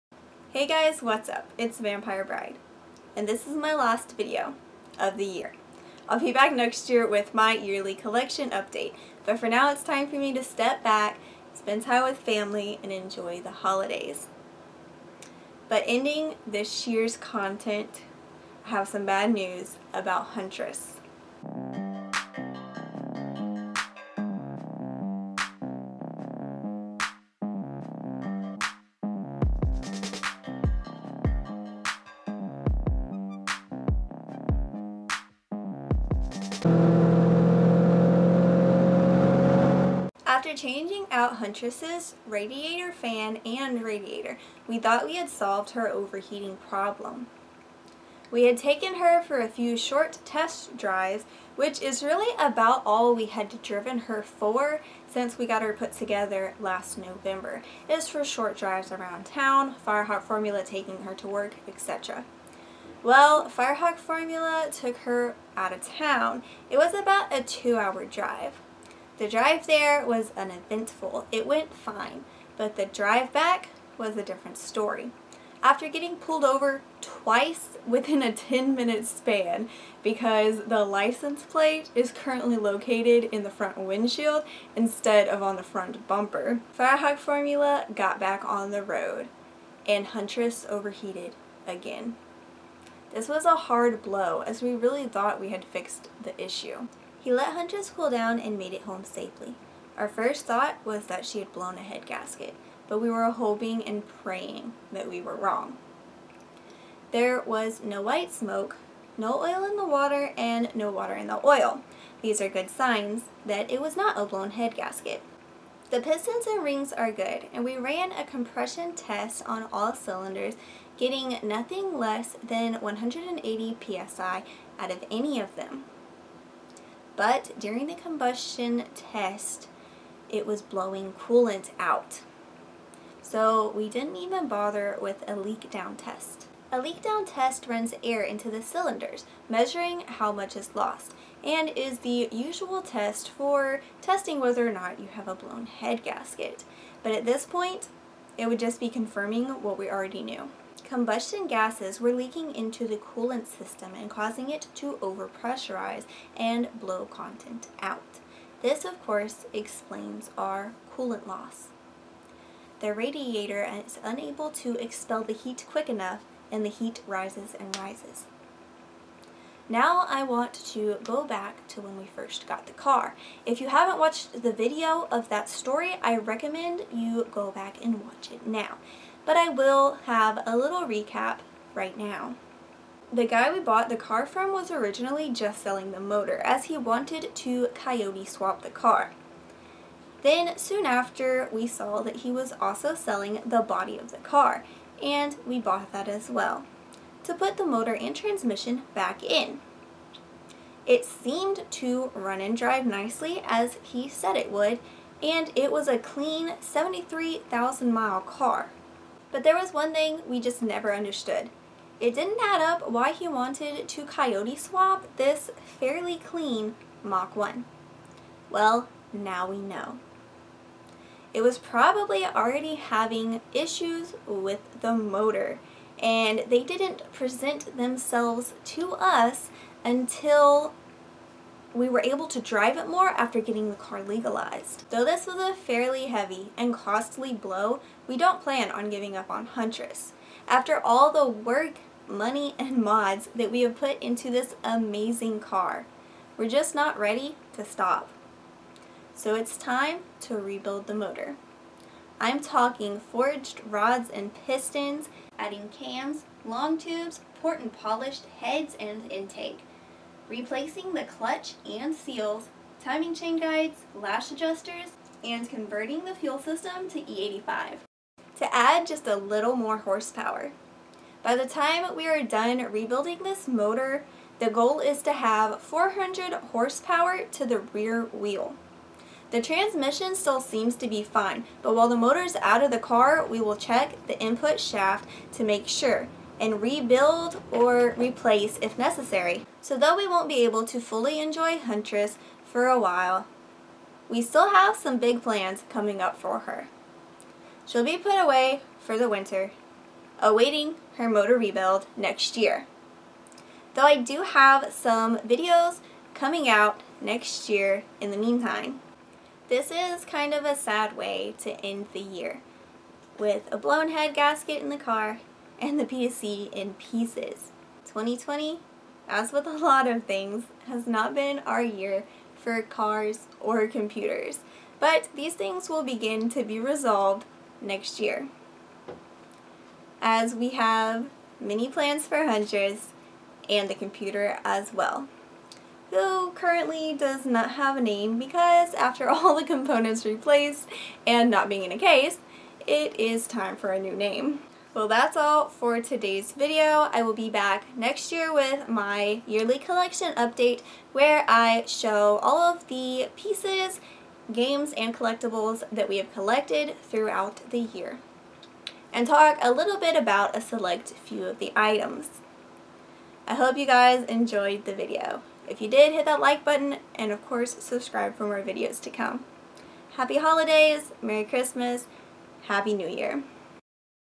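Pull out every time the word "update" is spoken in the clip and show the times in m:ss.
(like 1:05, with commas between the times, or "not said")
0:08, 5:50.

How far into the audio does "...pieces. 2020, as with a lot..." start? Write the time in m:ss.
5:16.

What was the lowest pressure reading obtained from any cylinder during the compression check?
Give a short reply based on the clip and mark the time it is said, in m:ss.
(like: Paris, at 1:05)
180 psi, at 2:02.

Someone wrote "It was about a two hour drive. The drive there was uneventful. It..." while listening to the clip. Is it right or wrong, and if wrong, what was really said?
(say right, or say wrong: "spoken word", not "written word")
right.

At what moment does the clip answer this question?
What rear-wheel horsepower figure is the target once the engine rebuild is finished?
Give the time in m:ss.
4:35.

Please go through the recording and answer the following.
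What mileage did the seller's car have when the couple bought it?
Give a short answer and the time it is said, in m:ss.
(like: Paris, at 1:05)
73,000 miles, at 3:26.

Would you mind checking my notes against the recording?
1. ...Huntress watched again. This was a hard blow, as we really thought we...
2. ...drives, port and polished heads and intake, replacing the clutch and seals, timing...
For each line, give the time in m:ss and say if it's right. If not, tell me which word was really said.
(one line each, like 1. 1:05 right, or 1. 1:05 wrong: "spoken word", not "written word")
1. 1:30 wrong: "overheated", not "watched"
2. 4:16 wrong: "tubes", not "drives".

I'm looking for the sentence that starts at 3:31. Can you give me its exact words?
It didn't add up why he wanted to coyote swap this fairly clean Mach 1.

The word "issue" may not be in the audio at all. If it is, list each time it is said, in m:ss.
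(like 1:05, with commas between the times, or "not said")
1:36, 3:43.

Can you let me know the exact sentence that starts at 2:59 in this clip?
But I will have a little recap right now.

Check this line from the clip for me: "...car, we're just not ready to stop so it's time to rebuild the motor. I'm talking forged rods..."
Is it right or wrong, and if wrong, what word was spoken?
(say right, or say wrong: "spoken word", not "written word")
right.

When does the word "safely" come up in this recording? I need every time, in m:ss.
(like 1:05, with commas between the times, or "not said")
1:39.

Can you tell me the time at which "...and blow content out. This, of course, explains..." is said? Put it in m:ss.
2:36.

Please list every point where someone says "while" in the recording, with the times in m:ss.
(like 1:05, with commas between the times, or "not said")
4:41, 4:52.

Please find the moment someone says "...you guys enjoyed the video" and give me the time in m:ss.
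6:03.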